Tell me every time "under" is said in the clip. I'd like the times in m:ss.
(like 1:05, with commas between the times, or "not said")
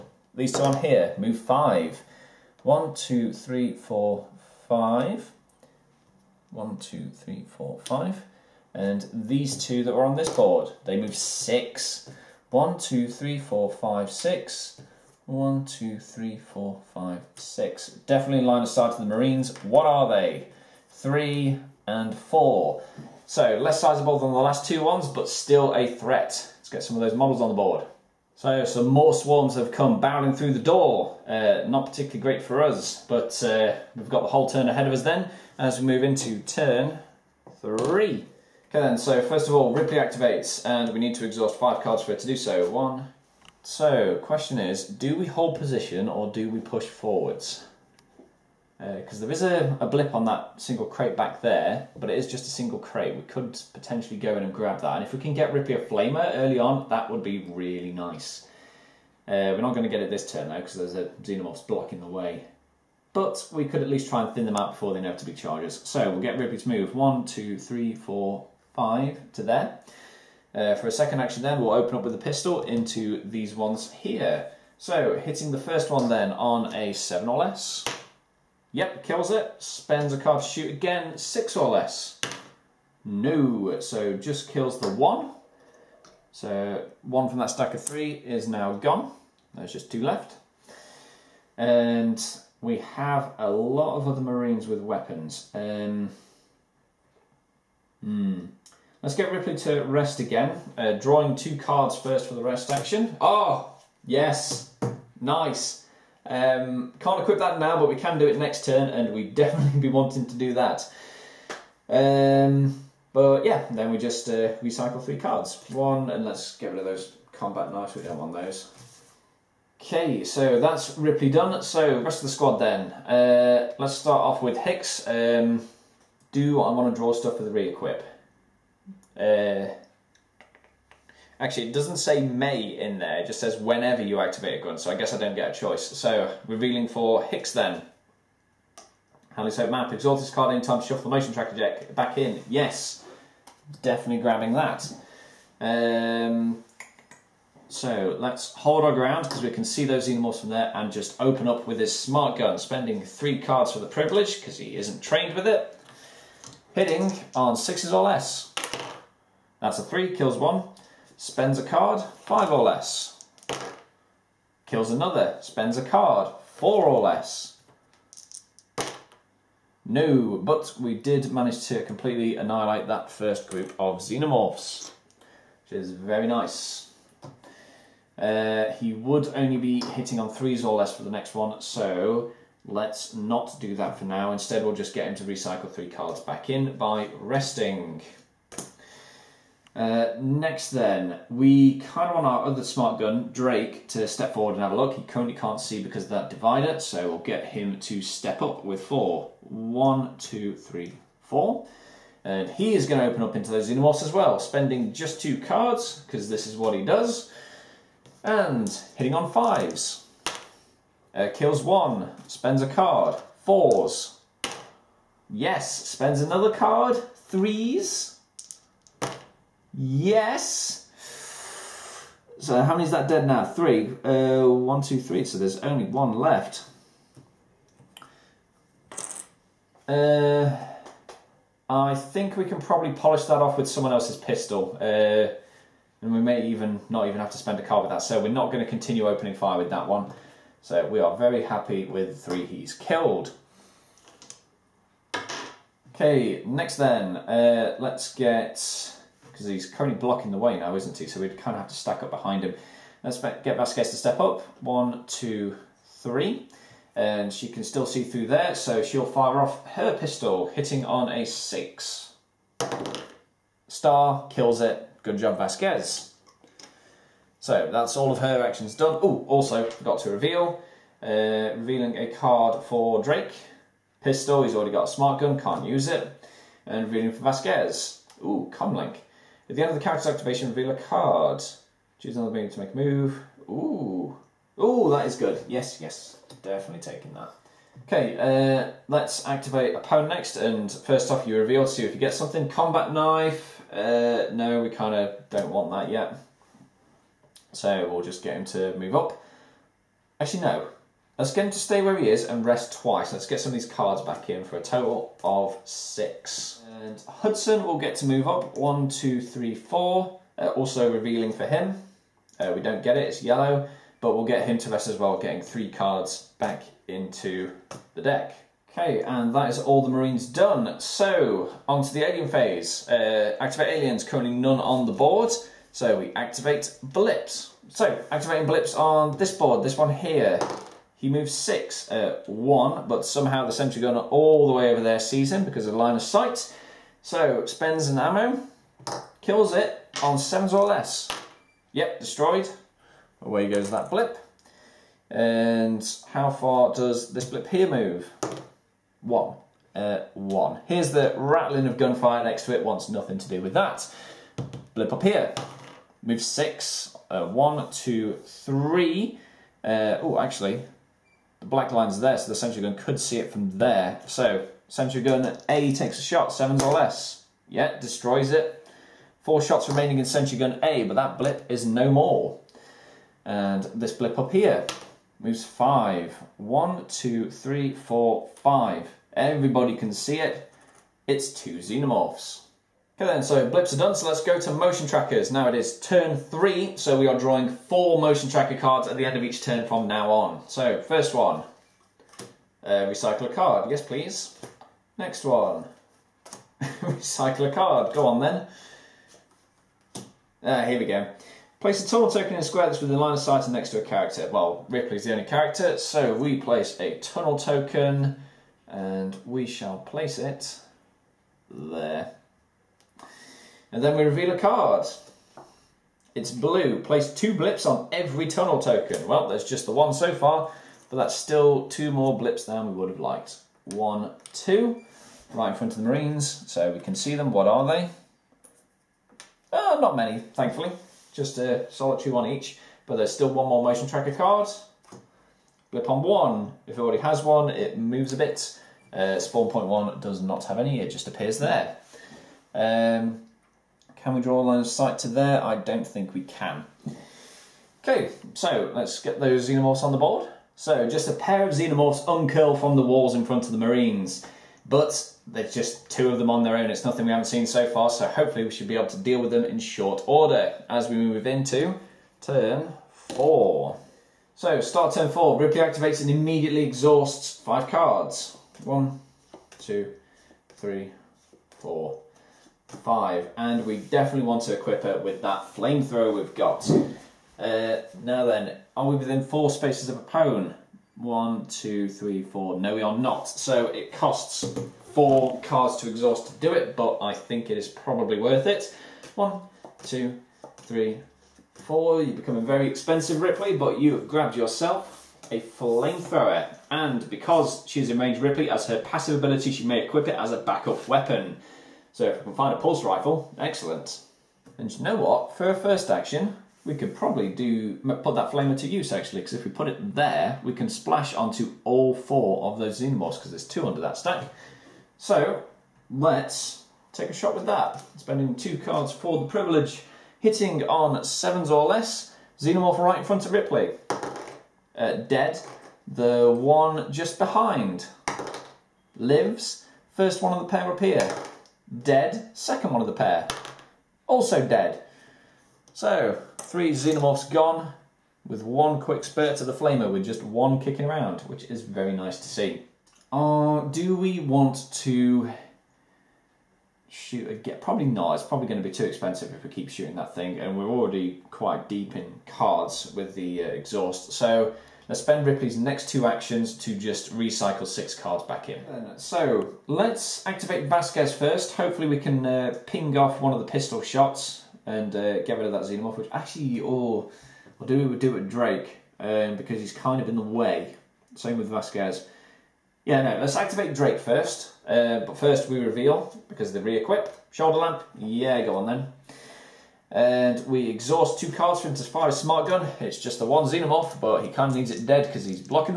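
8:33.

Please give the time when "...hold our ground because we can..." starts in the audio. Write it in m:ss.
2:28.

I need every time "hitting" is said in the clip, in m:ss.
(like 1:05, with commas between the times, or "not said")
1:15, 2:36, 2:59, 3:28, 4:20, 8:40.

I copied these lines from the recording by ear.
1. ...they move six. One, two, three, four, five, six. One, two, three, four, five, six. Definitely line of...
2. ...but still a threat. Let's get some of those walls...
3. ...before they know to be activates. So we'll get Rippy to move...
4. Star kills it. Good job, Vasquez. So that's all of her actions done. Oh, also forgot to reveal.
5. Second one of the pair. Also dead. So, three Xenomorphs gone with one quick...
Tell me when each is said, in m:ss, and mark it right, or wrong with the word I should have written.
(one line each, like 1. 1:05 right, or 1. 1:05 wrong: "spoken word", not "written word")
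1. 0:10 right
2. 0:25 wrong: "models", not "walls"
3. 1:04 wrong: "charges", not "activates"
4. 4:23 right
5. 8:52 right.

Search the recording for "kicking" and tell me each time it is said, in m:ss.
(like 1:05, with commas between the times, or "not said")
9:00.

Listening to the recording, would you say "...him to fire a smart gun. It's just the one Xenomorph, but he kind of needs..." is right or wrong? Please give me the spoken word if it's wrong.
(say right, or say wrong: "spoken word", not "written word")
right.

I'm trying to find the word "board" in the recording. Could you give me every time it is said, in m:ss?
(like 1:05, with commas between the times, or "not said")
0:10, 0:27, 5:24, 5:29, 7:29.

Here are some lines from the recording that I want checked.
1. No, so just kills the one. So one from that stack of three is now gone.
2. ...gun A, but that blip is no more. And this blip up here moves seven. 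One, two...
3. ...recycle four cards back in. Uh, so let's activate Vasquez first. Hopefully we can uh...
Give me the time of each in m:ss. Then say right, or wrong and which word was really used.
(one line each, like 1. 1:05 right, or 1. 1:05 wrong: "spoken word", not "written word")
1. 1:23 right
2. 6:10 wrong: "five", not "seven"
3. 9:17 wrong: "six", not "four".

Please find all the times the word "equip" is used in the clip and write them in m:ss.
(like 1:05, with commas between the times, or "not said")
1:47, 2:07, 7:54, 8:19, 9:36.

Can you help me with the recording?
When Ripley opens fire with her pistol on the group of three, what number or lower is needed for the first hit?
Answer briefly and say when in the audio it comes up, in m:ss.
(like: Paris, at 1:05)
7, at 1:16.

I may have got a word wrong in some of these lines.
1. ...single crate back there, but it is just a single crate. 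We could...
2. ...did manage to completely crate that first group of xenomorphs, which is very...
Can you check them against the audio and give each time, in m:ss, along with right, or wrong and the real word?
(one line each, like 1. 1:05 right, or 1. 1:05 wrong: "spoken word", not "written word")
1. 0:50 right
2. 2:50 wrong: "annihilate", not "crate".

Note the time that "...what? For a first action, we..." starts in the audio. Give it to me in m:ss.
8:24.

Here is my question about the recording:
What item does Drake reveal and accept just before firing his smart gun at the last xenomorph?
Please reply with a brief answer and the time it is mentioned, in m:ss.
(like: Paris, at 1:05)
shoulder lamp, at 9:37.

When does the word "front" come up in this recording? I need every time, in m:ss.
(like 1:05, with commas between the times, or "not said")
7:05, 7:33, 8:43.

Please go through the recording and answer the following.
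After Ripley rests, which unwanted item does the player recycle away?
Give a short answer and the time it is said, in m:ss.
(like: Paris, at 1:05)
combat knives, at 1:57.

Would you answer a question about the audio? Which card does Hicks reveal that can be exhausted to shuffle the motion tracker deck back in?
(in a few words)
Hadley's Hope map.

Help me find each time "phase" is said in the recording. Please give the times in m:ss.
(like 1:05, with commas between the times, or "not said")
5:22.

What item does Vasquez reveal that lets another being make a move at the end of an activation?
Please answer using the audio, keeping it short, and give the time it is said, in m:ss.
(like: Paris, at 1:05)
comlink, at 4:38.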